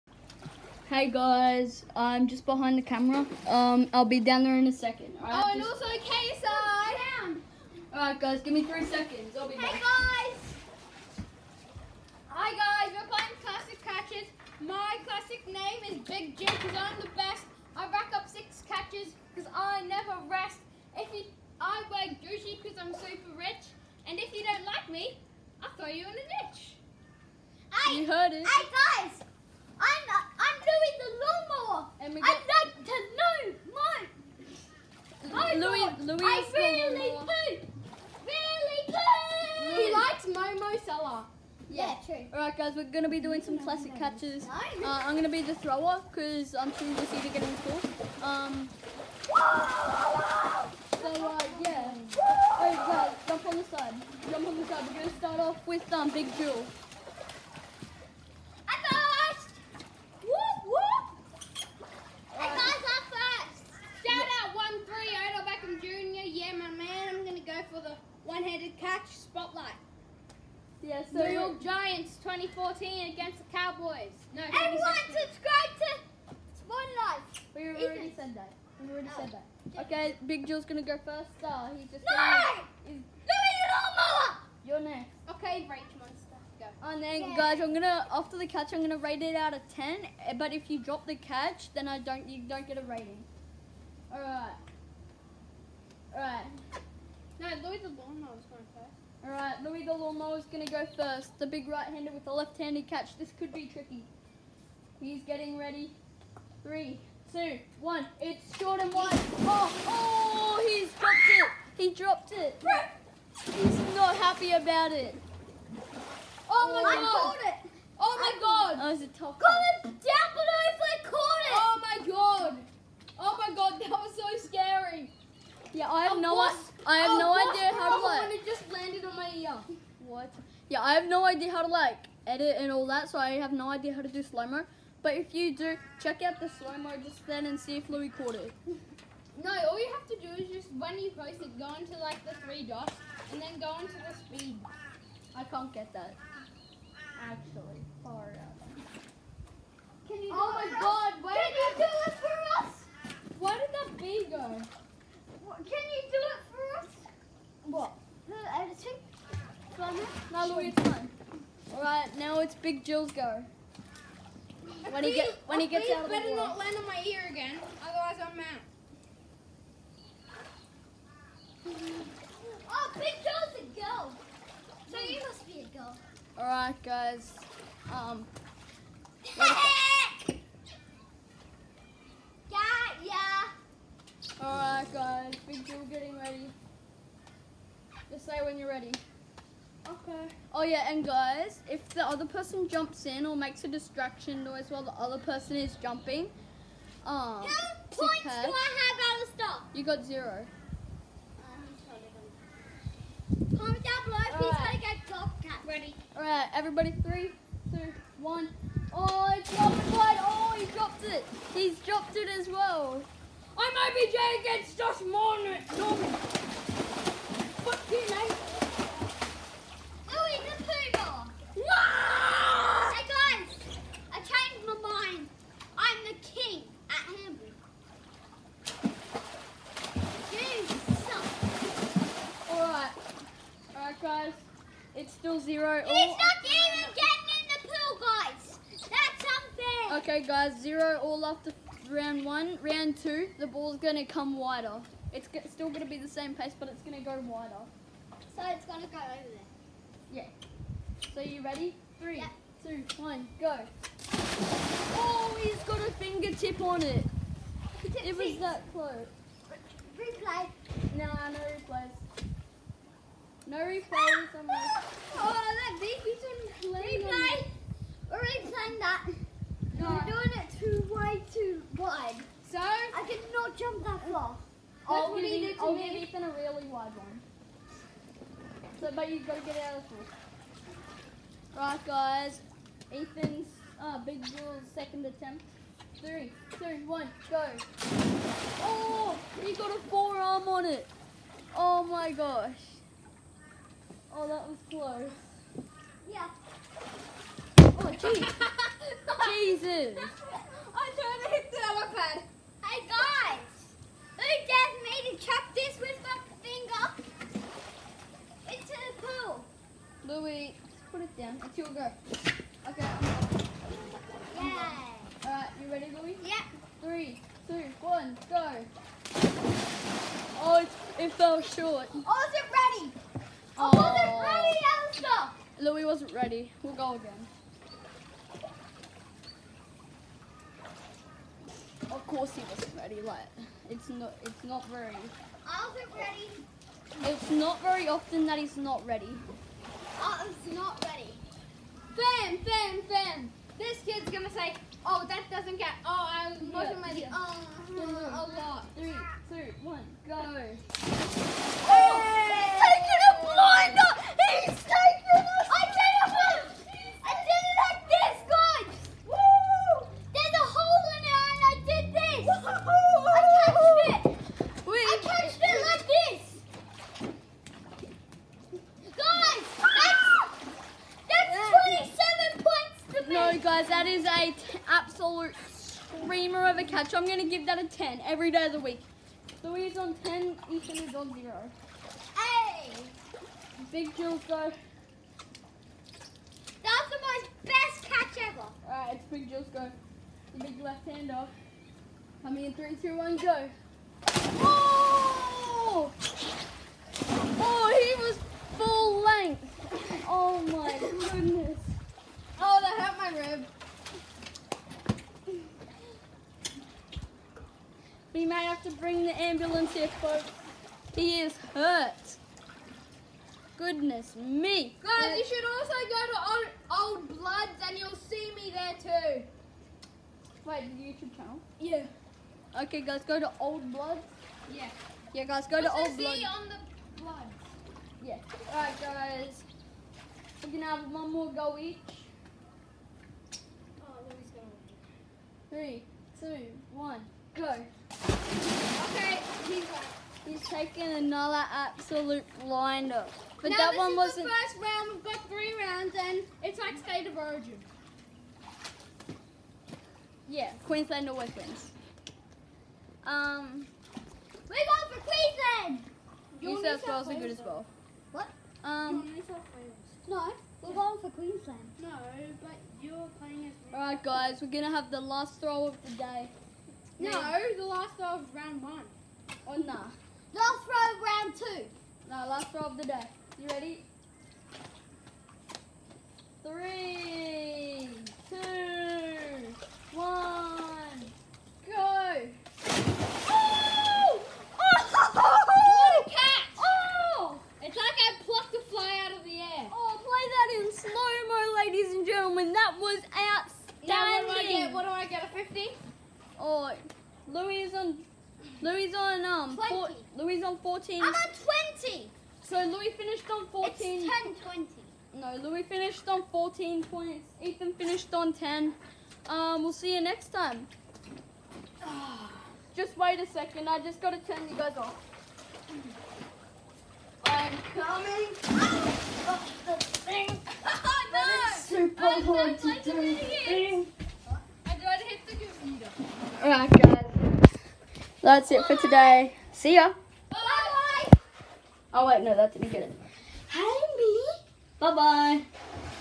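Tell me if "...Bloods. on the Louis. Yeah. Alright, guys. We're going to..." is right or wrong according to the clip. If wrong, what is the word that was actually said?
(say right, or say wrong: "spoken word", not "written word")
wrong: "Bloods", not "Louis".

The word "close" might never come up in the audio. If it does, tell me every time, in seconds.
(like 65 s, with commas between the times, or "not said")
258 s, 294 s.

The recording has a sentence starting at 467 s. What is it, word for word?
No, the last throw of round one.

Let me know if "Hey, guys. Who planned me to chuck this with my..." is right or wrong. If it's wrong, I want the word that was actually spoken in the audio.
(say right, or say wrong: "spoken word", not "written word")
wrong: "dared", not "planned".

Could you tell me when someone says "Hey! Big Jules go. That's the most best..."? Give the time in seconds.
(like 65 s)
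382 s.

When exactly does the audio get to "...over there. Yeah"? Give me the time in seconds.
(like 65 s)
248 s.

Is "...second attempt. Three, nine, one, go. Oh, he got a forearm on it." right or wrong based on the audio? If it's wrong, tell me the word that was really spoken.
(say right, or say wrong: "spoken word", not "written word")
wrong: "two", not "nine".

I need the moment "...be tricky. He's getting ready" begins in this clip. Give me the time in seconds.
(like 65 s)
103 s.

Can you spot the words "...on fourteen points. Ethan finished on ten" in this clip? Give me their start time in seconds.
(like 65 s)
506 s.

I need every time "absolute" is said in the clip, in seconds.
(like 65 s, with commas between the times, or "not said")
374 s, 441 s.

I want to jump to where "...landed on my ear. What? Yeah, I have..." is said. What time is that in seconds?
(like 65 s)
128 s.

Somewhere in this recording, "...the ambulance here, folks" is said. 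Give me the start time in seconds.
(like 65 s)
409 s.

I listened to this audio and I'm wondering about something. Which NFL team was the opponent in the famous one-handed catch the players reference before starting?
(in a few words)
Cowboys.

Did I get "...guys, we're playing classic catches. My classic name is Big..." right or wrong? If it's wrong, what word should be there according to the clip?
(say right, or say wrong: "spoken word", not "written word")
right.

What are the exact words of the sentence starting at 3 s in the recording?
Um, I'll be down there in a second.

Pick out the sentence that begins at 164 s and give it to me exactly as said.
When he get when he gets out of the better not land on my ear again, otherwise I'm out.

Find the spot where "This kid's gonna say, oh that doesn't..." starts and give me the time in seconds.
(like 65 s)
343 s.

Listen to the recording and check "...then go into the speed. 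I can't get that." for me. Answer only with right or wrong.
right.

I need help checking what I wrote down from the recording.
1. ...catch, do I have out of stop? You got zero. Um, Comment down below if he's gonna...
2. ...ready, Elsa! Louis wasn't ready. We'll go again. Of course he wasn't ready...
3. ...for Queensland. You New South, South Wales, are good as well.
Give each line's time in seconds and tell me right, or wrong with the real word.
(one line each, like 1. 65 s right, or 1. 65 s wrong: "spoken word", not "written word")
1. 198 s right
2. 324 s right
3. 454 s right.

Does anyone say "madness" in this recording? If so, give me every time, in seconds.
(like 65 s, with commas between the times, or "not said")
not said.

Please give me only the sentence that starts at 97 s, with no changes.
No, Louis the lawnmower is going first.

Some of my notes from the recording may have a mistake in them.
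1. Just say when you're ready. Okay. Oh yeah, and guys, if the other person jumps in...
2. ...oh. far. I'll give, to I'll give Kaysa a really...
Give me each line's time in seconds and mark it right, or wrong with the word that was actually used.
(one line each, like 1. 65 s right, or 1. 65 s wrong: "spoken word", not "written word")
1. 188 s right
2. 274 s wrong: "Ethan", not "Kaysa".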